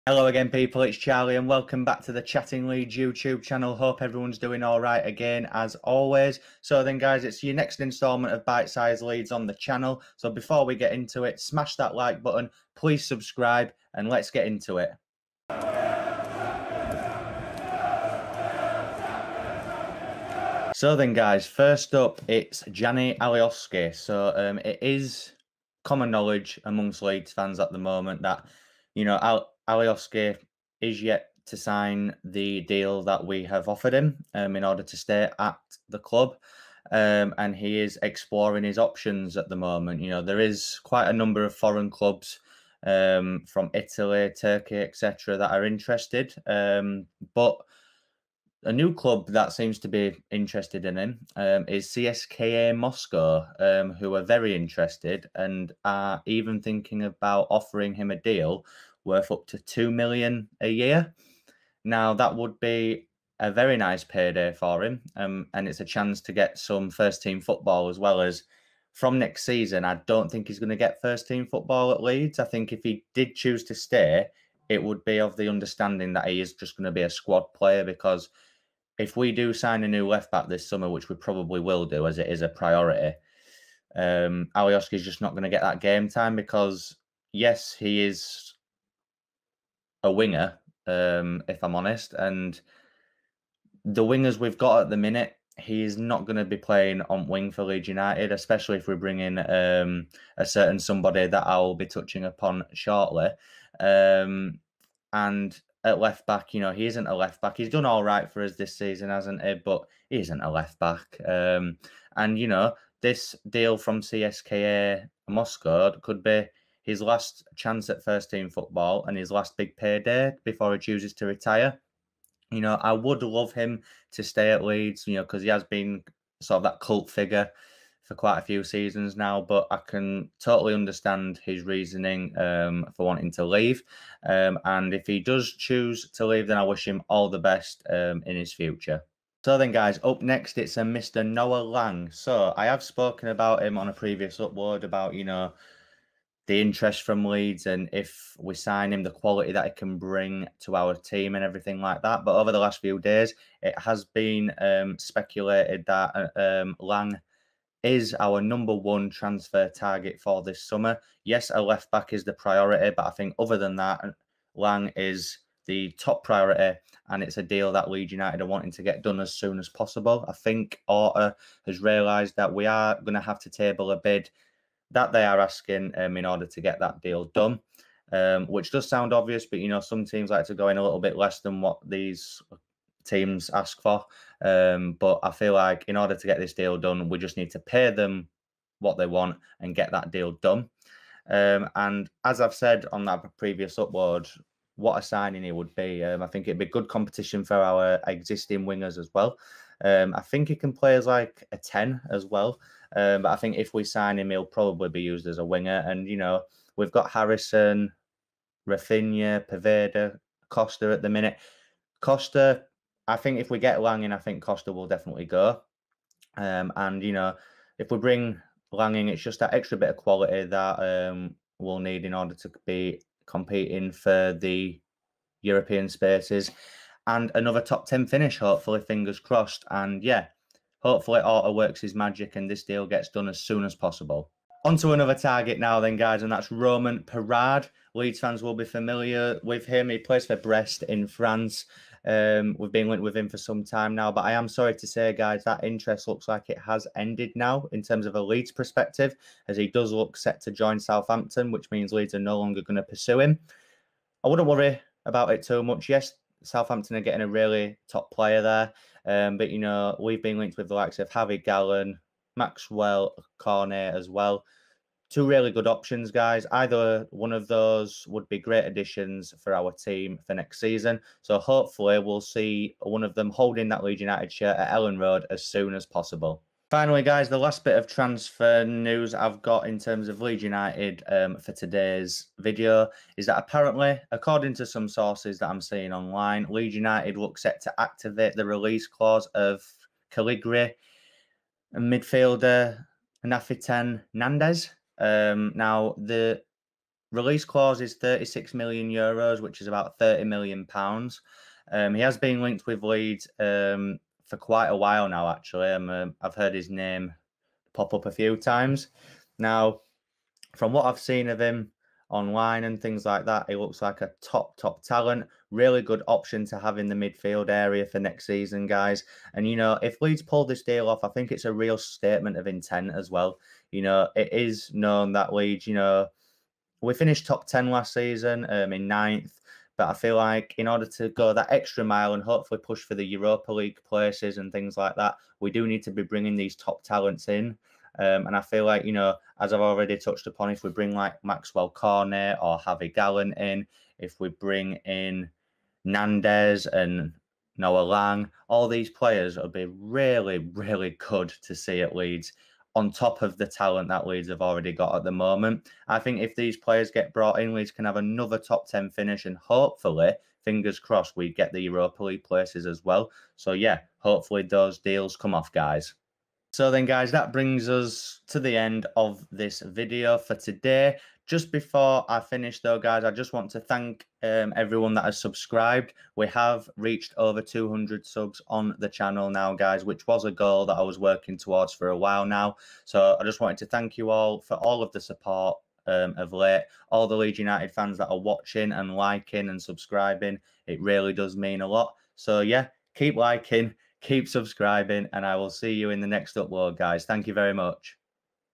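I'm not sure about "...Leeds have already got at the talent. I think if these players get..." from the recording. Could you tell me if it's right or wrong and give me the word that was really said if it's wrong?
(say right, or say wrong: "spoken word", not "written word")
wrong: "moment", not "talent".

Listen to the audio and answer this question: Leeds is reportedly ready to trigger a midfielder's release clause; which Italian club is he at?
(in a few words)
Cagliari.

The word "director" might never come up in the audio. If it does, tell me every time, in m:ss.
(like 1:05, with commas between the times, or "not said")
not said.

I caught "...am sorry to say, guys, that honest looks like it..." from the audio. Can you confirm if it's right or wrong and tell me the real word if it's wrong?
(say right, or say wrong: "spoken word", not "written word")
wrong: "interest", not "honest".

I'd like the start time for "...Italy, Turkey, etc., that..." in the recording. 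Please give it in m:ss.
0:43.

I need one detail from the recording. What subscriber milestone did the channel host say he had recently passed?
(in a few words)
200.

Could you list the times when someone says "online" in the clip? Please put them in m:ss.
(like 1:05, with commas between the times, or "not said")
4:45, 5:12.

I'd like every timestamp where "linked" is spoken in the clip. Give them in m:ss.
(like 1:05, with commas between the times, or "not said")
4:02, 4:20, 5:02.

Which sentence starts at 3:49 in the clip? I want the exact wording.
And yeah, hopefully, Orta works his magic and this deal gets done as soon as possible.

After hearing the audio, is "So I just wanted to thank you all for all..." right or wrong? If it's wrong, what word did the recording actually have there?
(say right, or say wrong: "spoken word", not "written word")
right.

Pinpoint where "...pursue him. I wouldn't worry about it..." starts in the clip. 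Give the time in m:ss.
4:12.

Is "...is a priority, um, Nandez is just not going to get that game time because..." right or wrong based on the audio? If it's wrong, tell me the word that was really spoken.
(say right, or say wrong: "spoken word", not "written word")
wrong: "Alioski", not "Nandez".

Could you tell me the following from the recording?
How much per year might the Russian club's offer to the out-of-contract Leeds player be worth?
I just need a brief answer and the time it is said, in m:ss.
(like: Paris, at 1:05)
2 million, at 0:59.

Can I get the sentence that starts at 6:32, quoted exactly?
So, yeah, keep liking, keep subscribing, and I will see you in the next upload, guys.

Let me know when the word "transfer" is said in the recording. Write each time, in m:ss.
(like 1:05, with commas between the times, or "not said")
2:39, 4:37.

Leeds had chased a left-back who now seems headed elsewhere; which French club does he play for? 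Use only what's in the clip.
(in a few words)
Brest.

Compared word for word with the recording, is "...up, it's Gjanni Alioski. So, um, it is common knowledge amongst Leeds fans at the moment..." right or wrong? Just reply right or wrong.
right.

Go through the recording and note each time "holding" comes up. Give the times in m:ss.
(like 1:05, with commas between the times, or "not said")
4:33.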